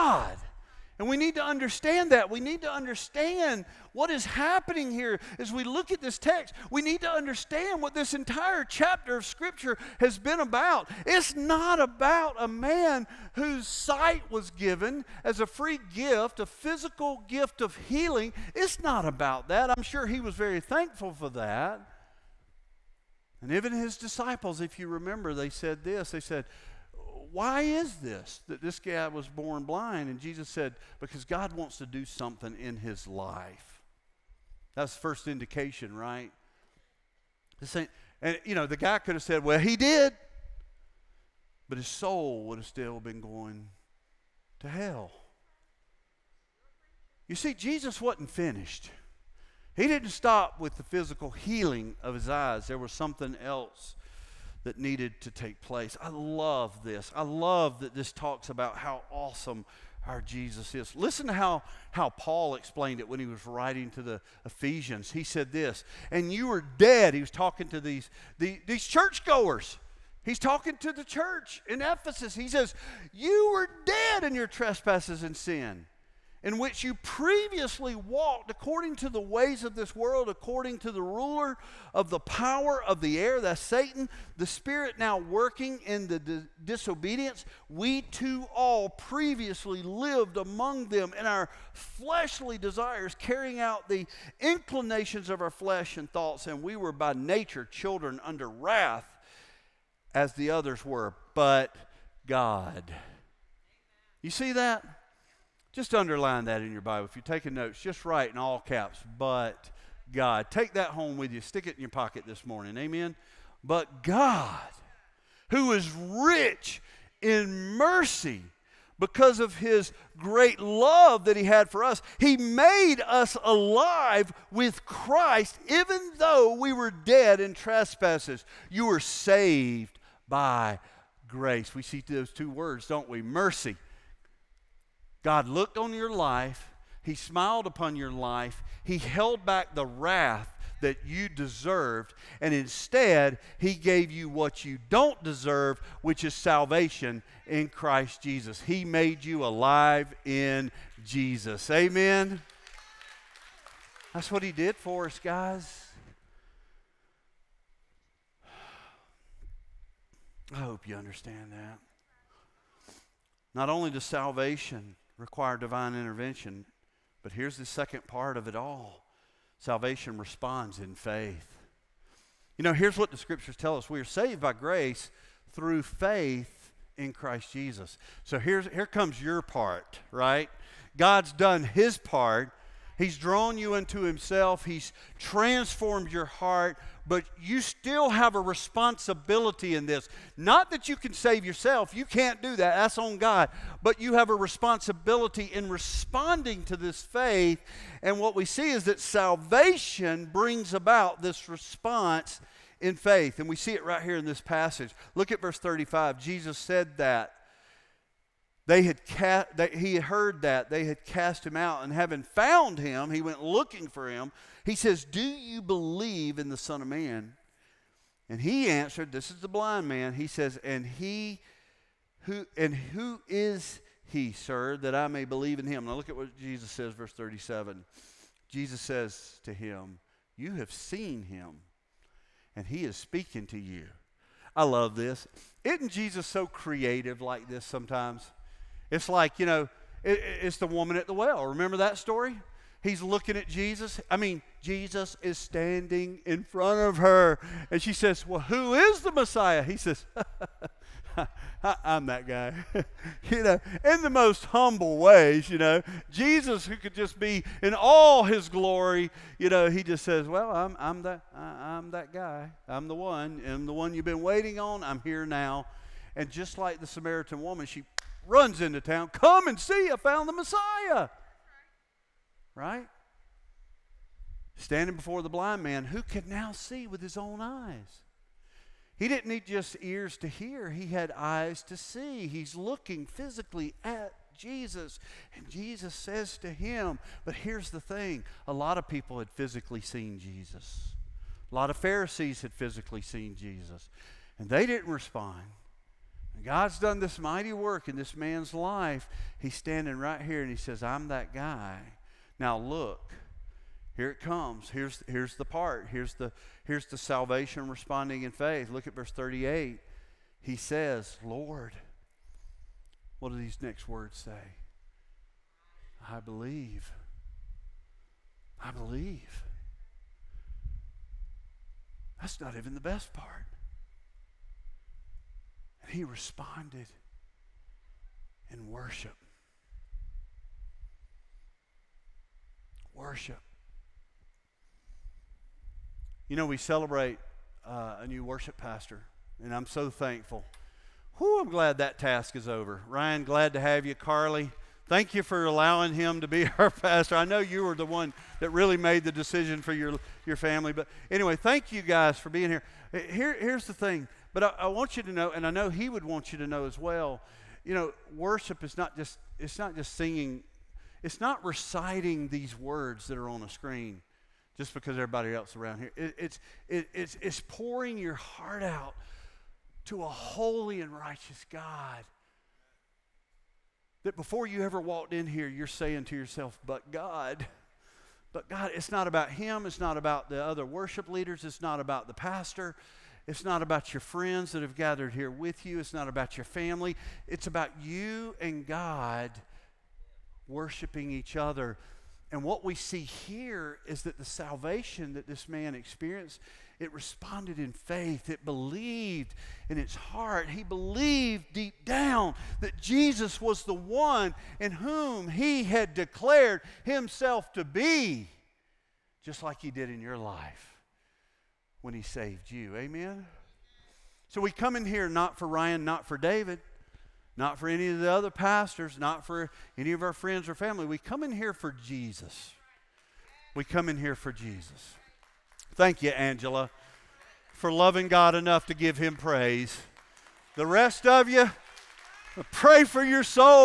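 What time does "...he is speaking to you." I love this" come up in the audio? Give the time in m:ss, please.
3:52.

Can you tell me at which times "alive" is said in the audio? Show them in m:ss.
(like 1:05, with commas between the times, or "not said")
2:03, 2:29.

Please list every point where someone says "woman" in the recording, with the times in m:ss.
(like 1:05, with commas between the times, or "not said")
4:00, 4:27.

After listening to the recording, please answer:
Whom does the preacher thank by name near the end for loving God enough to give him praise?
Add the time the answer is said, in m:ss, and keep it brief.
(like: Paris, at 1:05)
Angela, at 7:06.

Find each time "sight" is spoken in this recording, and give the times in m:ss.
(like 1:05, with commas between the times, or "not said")
0:13.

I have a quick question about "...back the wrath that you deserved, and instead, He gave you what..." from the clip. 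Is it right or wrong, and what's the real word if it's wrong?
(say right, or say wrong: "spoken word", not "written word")
right.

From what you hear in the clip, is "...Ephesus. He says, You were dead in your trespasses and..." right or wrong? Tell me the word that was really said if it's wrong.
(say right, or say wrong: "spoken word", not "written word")
right.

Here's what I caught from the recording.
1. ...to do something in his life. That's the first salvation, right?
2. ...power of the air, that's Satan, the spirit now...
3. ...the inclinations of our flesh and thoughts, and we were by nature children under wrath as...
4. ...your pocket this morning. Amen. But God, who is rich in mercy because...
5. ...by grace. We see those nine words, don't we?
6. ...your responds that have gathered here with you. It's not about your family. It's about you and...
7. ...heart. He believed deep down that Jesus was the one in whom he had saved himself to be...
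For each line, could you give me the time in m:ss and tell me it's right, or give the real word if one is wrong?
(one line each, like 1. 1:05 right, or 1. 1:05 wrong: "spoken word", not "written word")
1. 0:31 wrong: "indication", not "salvation"
2. 1:22 right
3. 1:33 right
4. 1:51 right
5. 2:10 wrong: "two", not "nine"
6. 6:23 wrong: "friends", not "responds"
7. 6:39 wrong: "declared", not "saved".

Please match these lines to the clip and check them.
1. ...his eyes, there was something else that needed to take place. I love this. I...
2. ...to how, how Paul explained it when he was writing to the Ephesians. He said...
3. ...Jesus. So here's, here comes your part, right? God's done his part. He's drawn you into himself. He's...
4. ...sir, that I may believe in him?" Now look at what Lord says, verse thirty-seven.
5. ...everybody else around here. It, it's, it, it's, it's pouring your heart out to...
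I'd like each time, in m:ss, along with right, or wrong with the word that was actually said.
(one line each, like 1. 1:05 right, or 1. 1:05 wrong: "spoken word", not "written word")
1. 0:52 right
2. 1:01 right
3. 2:57 right
4. 3:44 wrong: "Jesus", not "Lord"
5. 6:04 right.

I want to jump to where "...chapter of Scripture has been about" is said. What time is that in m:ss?
0:08.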